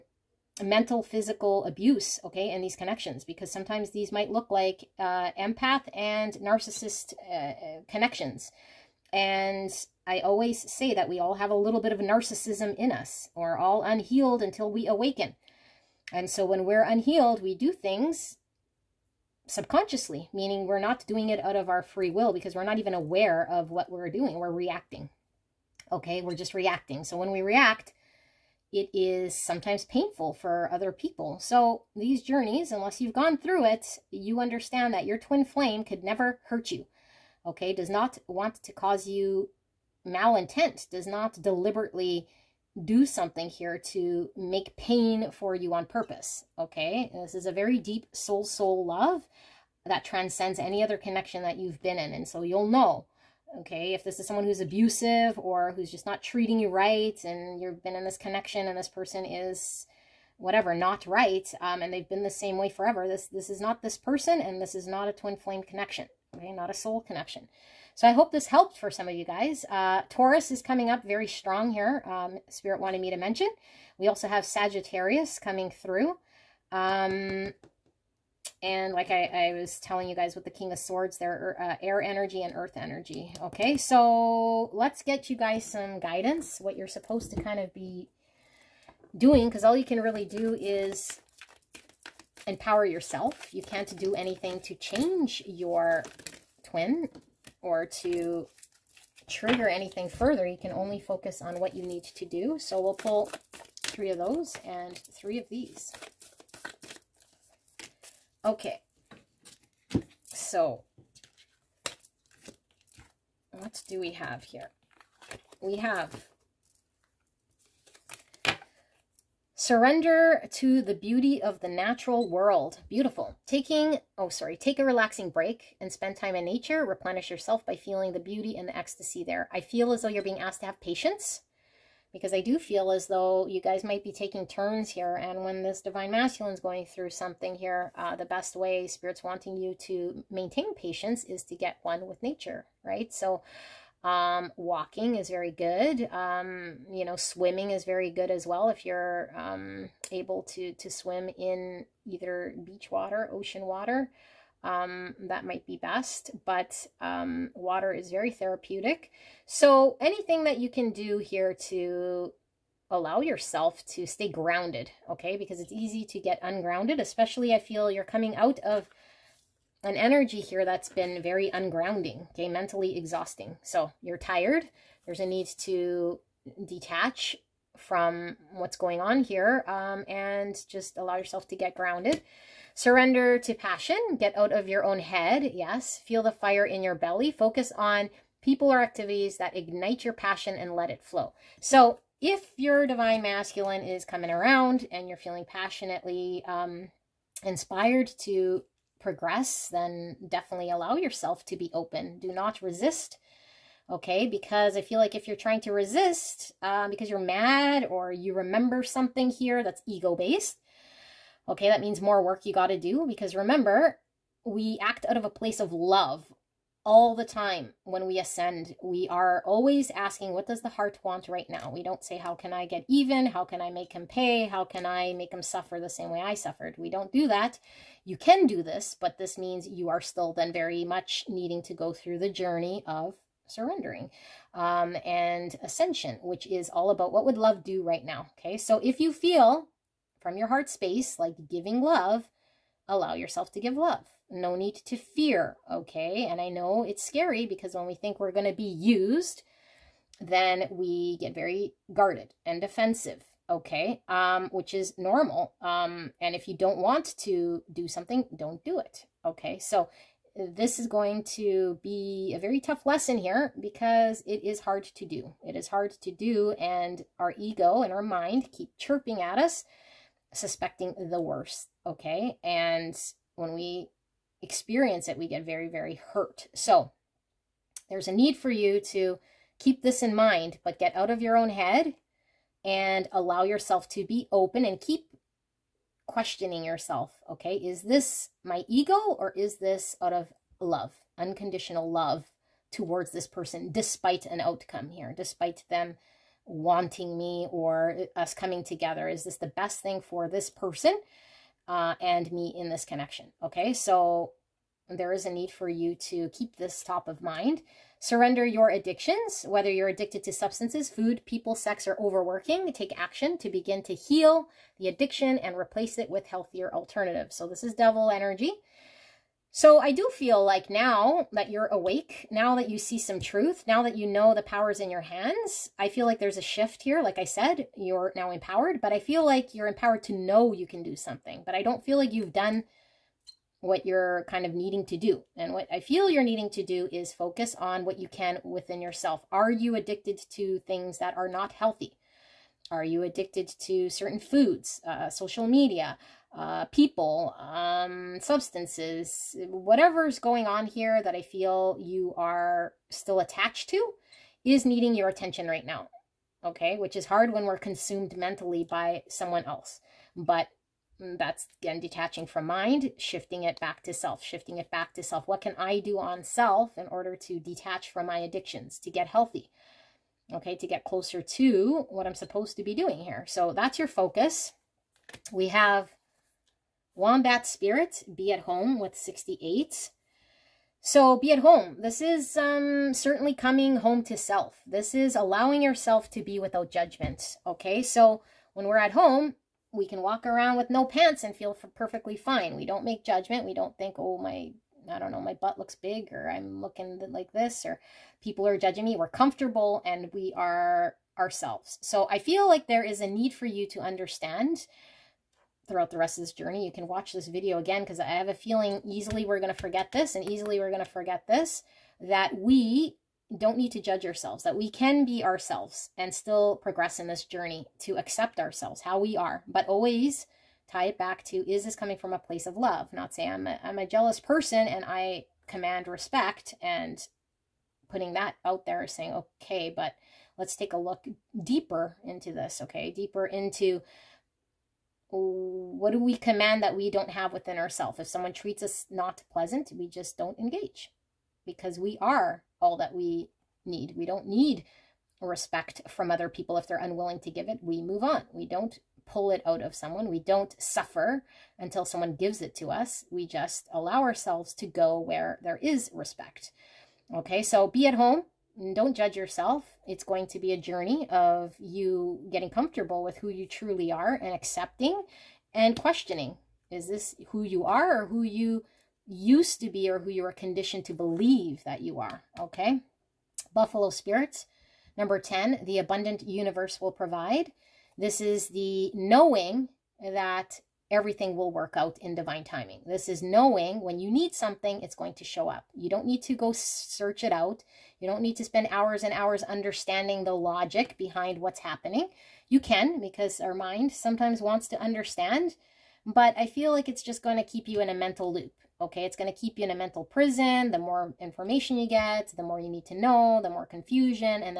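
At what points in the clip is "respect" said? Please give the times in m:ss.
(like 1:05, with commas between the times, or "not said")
7:05, 7:25, 7:35.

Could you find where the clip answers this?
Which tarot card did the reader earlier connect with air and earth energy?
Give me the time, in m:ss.
1:20.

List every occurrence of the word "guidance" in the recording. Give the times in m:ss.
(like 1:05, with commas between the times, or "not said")
1:25.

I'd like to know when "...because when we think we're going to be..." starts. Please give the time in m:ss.
4:07.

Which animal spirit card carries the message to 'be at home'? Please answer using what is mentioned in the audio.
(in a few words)
Wombat.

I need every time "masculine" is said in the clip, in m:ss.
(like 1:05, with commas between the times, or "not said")
2:16, 3:13.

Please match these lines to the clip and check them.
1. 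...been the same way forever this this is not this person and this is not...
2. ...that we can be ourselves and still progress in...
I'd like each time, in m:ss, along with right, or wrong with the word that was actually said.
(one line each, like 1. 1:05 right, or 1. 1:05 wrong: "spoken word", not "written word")
1. 1:02 right
2. 6:54 right.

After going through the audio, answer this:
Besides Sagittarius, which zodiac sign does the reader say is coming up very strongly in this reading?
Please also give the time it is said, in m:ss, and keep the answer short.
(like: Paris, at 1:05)
Taurus, at 1:10.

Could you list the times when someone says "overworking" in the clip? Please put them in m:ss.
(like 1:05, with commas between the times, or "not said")
5:11.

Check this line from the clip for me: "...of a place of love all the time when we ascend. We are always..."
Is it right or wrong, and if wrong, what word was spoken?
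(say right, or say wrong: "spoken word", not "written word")
right.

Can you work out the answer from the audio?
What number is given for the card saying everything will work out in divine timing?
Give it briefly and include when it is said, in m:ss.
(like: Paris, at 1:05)
10, at 7:55.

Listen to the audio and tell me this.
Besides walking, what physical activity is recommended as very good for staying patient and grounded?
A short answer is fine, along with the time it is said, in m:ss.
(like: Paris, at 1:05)
Swimming, at 2:27.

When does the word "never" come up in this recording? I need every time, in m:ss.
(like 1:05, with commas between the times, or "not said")
0:36.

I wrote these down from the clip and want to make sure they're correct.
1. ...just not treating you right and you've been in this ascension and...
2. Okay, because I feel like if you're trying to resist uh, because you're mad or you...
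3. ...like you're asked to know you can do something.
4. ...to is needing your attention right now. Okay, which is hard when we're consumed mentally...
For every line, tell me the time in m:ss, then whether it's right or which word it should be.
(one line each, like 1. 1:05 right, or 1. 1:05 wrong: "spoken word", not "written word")
1. 0:55 wrong: "connection", not "ascension"
2. 3:23 right
3. 5:29 wrong: "empowered", not "asked"
4. 5:53 right.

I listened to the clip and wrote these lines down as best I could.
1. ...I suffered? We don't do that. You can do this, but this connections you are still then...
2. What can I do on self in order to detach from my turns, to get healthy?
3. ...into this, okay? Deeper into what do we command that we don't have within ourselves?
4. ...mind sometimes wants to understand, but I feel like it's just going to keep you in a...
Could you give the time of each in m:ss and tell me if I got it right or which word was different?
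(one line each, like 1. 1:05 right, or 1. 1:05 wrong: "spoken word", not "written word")
1. 3:46 wrong: "means", not "connections"
2. 6:05 wrong: "addictions", not "turns"
3. 7:12 right
4. 8:13 right.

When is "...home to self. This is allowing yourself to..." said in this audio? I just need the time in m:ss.
6:23.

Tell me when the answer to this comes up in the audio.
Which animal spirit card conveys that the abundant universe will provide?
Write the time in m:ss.
7:53.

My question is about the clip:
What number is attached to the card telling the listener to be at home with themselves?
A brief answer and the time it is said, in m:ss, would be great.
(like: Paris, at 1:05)
68, at 6:18.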